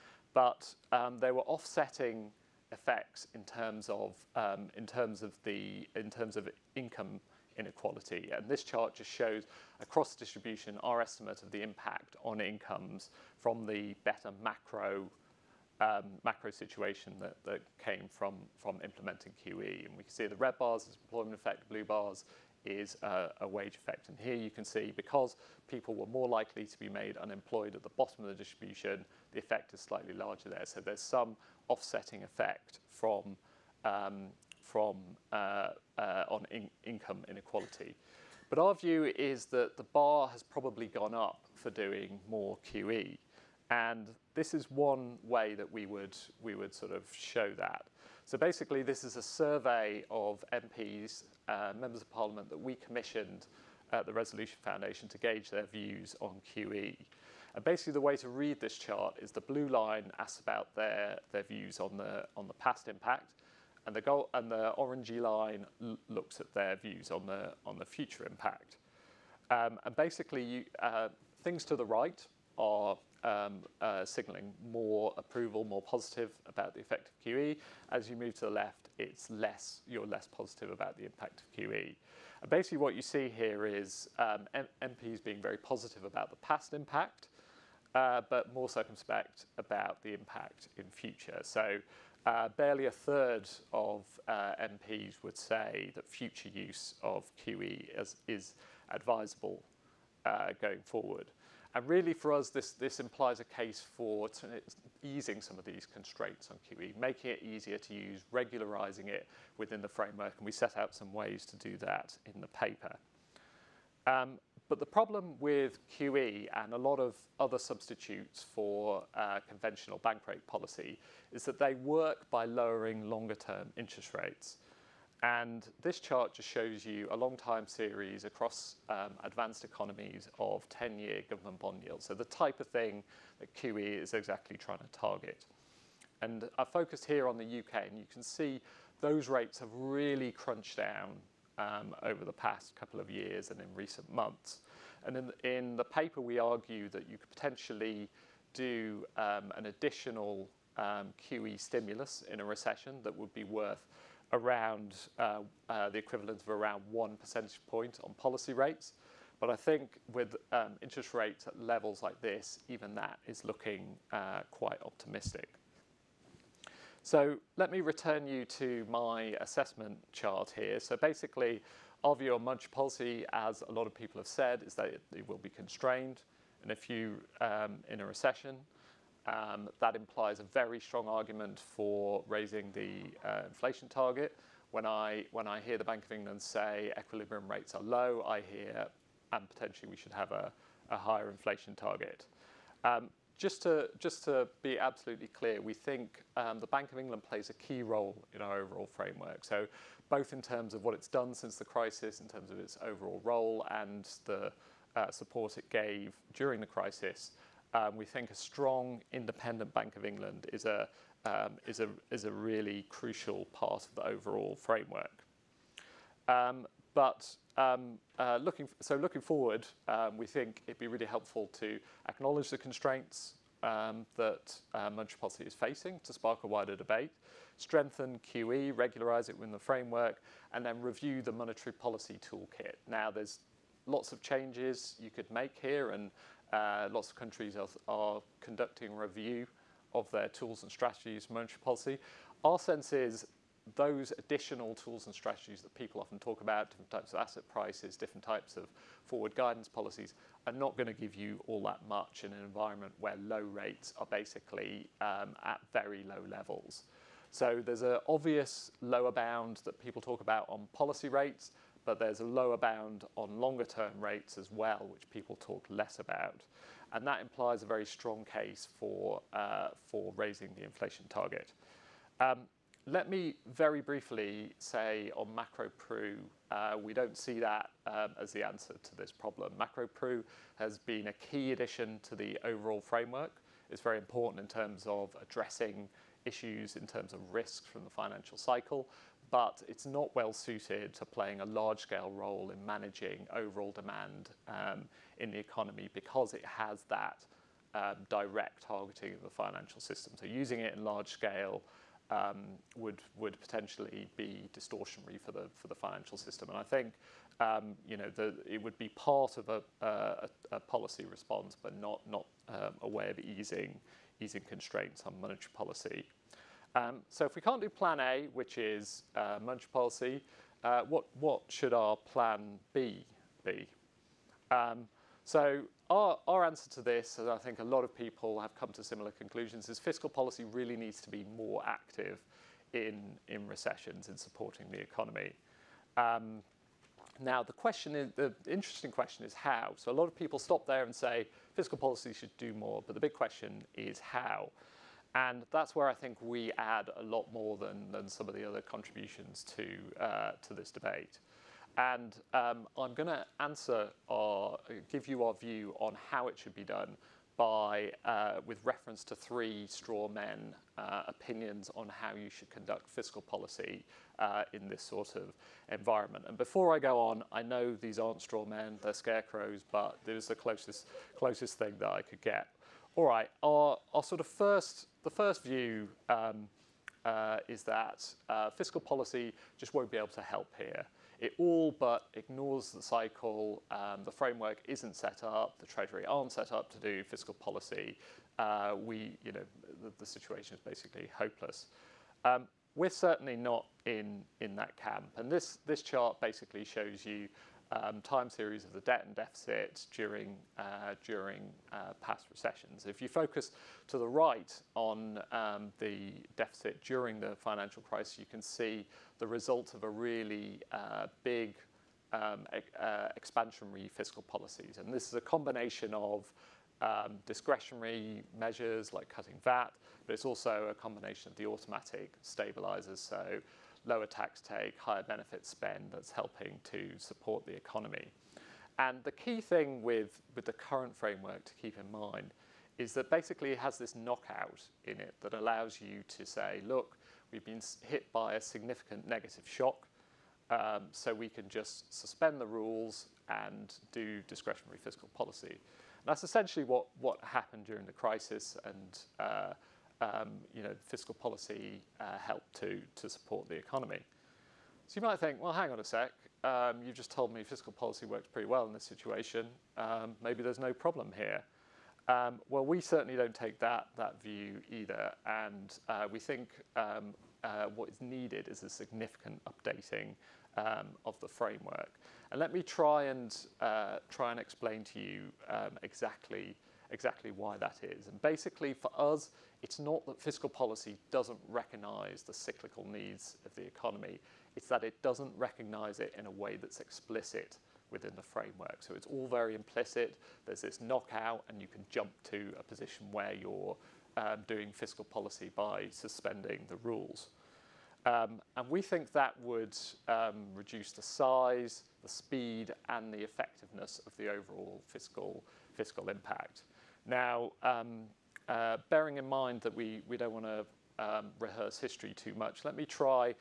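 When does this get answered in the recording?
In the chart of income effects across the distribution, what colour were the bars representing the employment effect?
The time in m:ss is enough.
0:20.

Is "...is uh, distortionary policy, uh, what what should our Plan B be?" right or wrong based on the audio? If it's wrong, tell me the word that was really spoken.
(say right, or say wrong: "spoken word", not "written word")
wrong: "monetary", not "distortionary".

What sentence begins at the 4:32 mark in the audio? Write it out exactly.
Um, let me very briefly say on MacroPru, uh, we don't see that um, as the answer to this problem.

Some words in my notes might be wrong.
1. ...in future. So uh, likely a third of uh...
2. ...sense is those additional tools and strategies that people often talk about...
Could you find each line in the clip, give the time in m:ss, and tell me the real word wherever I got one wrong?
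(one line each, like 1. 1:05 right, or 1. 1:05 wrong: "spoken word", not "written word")
1. 1:30 wrong: "barely", not "likely"
2. 4:02 right.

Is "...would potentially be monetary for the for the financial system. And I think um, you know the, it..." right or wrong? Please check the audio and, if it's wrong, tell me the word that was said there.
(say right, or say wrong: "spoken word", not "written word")
wrong: "distortionary", not "monetary".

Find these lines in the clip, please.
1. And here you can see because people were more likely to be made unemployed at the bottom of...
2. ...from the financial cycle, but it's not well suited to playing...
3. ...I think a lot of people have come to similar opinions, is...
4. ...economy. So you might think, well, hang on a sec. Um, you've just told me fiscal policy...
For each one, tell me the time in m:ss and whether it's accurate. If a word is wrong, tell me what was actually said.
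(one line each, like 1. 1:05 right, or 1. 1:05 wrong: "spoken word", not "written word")
1. 0:24 right
2. 4:47 right
3. 5:27 wrong: "conclusions", not "opinions"
4. 7:33 right.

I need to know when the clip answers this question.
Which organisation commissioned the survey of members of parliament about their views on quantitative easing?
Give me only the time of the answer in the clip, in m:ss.
0:54.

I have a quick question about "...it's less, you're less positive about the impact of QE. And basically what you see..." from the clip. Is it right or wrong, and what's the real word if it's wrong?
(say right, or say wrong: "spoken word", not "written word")
right.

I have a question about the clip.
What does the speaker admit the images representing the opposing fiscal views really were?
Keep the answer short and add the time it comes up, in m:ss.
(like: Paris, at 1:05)
Scarecrows, at 6:08.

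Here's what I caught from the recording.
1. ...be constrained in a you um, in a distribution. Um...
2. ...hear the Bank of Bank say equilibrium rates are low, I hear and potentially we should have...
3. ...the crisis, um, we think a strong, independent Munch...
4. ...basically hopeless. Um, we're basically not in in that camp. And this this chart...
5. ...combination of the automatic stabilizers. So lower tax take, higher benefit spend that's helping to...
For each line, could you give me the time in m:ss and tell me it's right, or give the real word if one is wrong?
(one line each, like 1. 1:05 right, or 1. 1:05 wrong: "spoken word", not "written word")
1. 2:55 wrong: "recession", not "distribution"
2. 3:05 wrong: "England", not "Bank"
3. 3:26 wrong: "Bank", not "Munch"
4. 6:30 wrong: "certainly", not "basically"
5. 7:00 right.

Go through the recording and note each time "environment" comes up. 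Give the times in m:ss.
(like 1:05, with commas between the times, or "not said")
4:12, 6:05.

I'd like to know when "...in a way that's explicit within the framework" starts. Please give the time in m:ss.
8:06.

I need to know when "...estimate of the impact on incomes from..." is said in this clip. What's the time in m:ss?
0:10.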